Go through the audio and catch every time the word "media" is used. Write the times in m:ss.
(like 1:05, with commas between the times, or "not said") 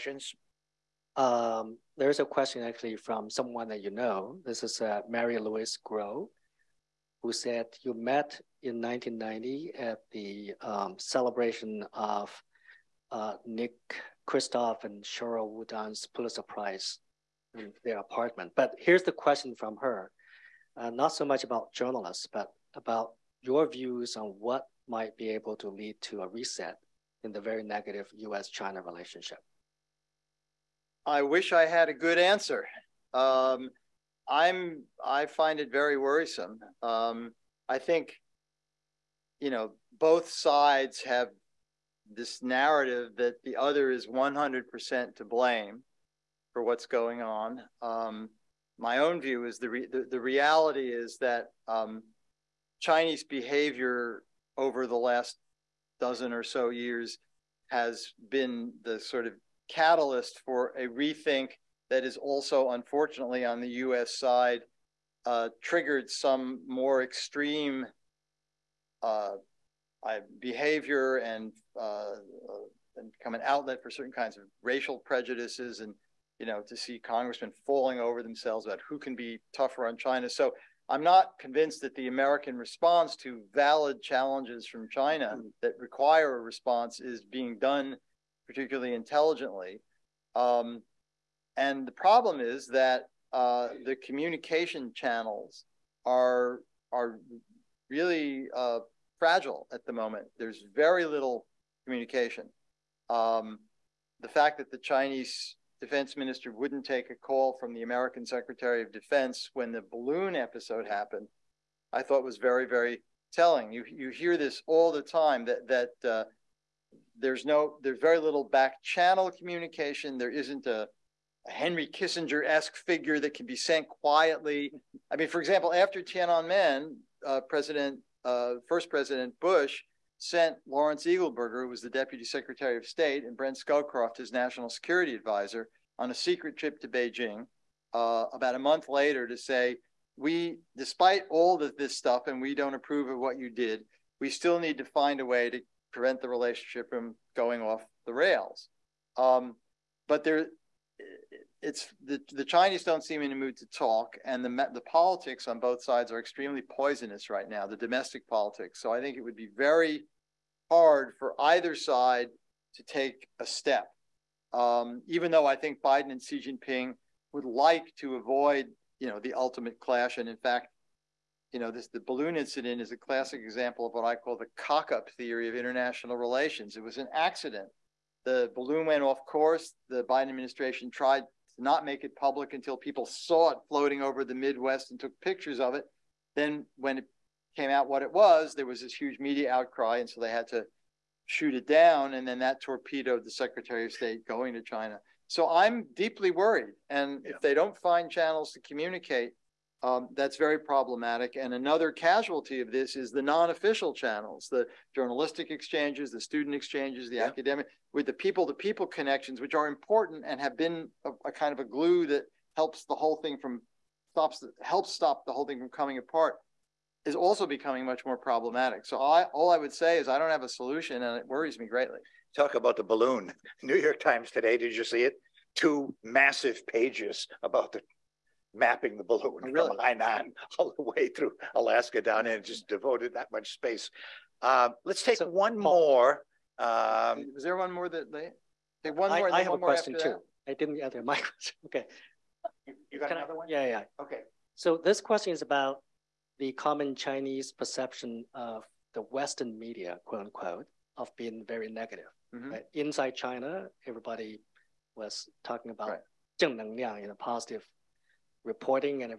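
3:09, 4:09.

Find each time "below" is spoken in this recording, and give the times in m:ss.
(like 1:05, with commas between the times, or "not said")
not said.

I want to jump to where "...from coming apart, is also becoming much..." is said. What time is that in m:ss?
3:35.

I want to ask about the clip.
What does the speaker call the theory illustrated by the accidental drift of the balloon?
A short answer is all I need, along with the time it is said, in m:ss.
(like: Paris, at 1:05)
cock-up theory, at 2:54.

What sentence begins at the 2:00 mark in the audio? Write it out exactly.
There isn't a a Henry Kissinger-esque figure that can be sent quietly.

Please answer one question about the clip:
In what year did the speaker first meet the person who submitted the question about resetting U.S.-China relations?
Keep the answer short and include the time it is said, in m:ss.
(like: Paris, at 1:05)
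1990, at 0:08.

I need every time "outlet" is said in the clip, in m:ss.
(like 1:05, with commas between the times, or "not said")
1:13.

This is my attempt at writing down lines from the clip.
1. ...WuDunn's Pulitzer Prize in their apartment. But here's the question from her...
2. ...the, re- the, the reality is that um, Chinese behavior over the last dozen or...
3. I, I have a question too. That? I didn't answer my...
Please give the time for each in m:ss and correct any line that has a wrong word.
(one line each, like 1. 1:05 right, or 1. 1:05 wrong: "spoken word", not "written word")
1. 0:15 right
2. 0:49 right
3. 3:59 right.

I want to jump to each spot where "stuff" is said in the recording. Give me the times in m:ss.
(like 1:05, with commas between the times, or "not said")
2:21.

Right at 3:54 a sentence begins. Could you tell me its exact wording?
Uh, let's take so, one more.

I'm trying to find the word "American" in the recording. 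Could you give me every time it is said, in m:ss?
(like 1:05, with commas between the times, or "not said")
1:22, 1:47.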